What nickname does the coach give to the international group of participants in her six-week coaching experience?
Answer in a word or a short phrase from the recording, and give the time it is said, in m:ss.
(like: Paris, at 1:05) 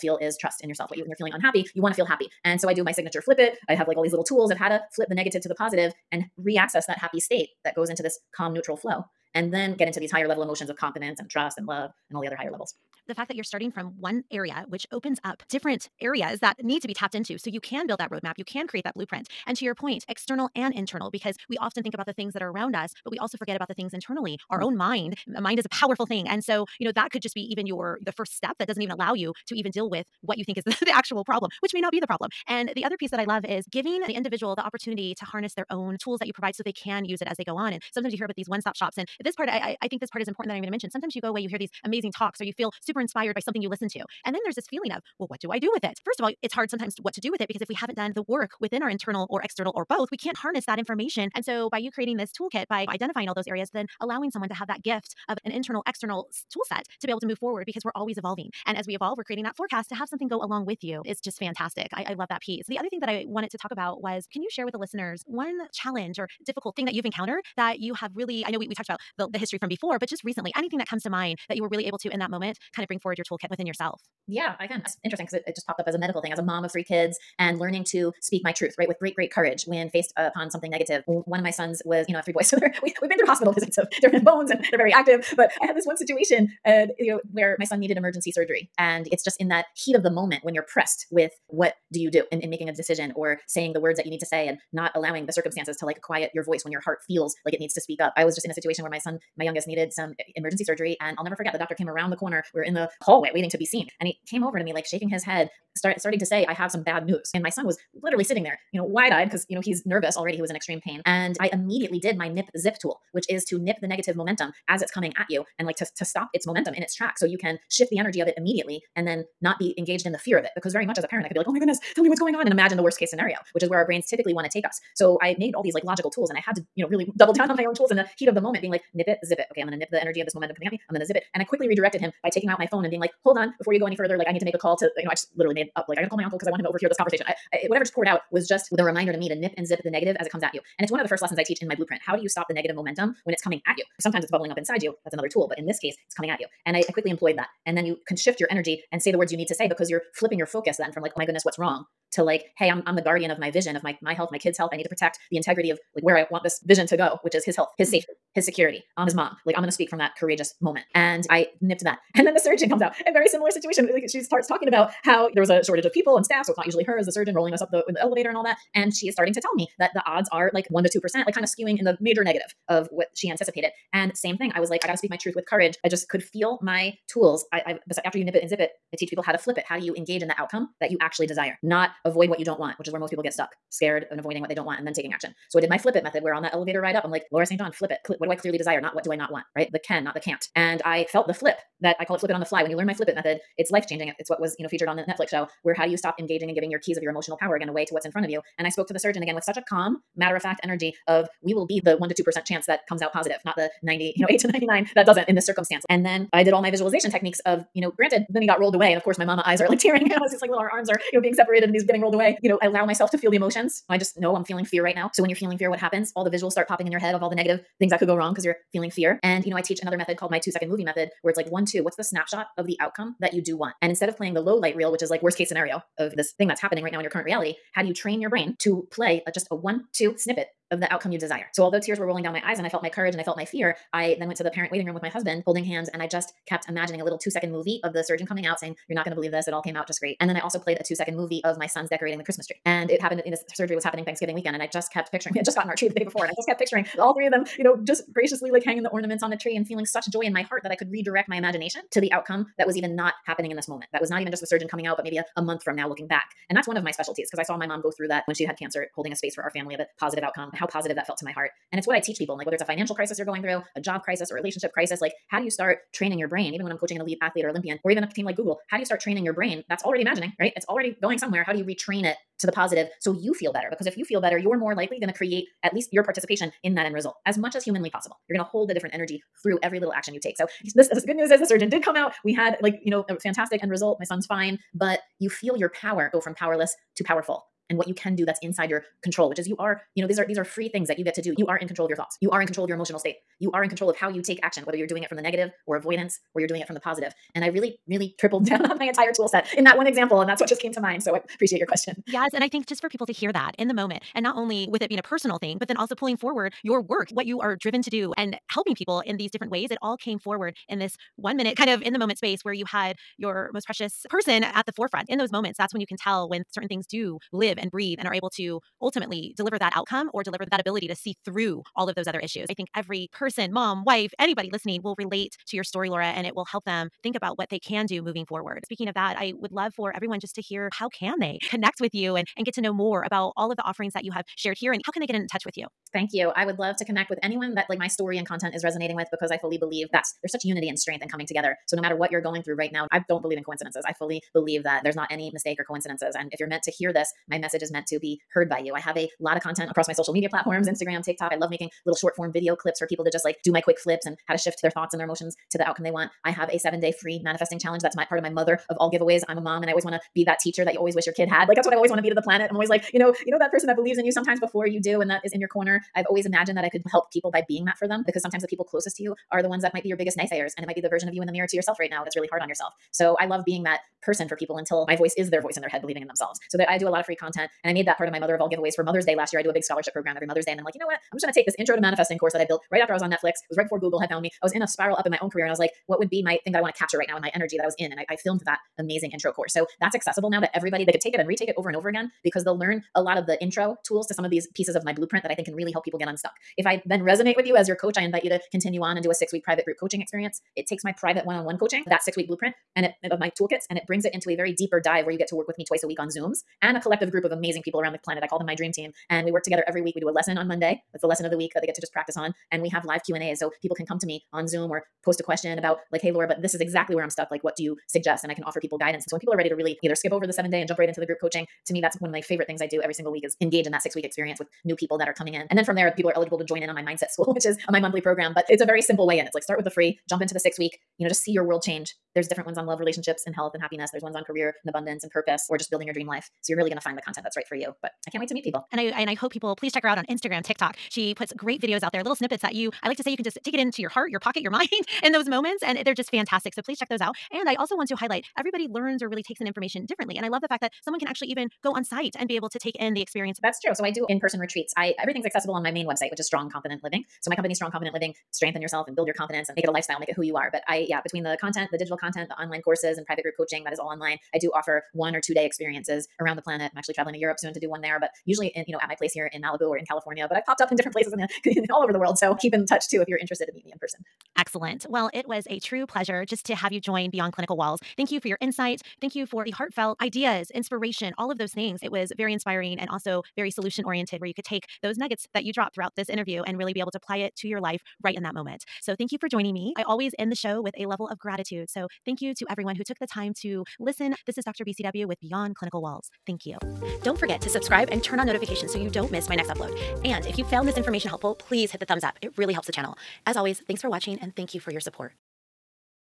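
Dream team, at 6:48.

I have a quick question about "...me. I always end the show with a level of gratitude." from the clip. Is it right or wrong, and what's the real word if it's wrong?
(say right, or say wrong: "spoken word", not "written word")
right.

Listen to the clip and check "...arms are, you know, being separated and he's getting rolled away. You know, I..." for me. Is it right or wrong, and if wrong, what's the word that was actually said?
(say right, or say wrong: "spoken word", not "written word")
right.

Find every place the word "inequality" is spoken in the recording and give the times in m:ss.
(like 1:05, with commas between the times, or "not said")
not said.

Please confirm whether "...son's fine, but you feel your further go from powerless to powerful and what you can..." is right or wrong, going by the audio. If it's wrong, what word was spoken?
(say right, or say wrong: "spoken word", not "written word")
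wrong: "power", not "further".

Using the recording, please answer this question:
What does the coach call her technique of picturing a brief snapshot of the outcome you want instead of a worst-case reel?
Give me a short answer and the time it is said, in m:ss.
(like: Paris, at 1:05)
Two second movie method, at 3:40.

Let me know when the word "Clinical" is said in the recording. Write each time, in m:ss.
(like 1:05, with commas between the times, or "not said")
7:57, 8:15.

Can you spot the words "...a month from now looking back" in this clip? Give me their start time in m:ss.
4:15.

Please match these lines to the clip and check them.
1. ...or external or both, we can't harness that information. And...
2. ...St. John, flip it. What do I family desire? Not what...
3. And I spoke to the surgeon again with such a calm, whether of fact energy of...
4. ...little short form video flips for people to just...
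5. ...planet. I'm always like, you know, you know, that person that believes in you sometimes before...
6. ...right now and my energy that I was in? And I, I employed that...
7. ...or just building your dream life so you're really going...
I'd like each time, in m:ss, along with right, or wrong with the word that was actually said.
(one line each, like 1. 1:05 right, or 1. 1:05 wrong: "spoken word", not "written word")
1. 0:49 right
2. 3:07 wrong: "clearly", not "family"
3. 3:18 wrong: "matter", not "whether"
4. 5:51 wrong: "clips", not "flips"
5. 6:02 right
6. 6:26 wrong: "filmed", not "employed"
7. 7:15 right.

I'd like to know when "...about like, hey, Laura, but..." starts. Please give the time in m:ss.
6:55.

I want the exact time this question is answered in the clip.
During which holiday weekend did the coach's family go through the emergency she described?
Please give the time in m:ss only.
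4:04.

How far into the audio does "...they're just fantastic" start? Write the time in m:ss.
7:25.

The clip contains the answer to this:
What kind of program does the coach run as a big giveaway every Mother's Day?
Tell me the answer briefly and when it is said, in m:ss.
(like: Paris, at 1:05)
Scholarship program, at 6:19.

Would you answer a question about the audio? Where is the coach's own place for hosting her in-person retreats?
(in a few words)
Malibu.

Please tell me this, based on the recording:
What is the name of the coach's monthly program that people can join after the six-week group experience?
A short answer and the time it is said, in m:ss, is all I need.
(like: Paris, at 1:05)
Mindset school, at 7:06.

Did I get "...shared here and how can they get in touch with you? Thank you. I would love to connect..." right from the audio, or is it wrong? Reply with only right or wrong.
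right.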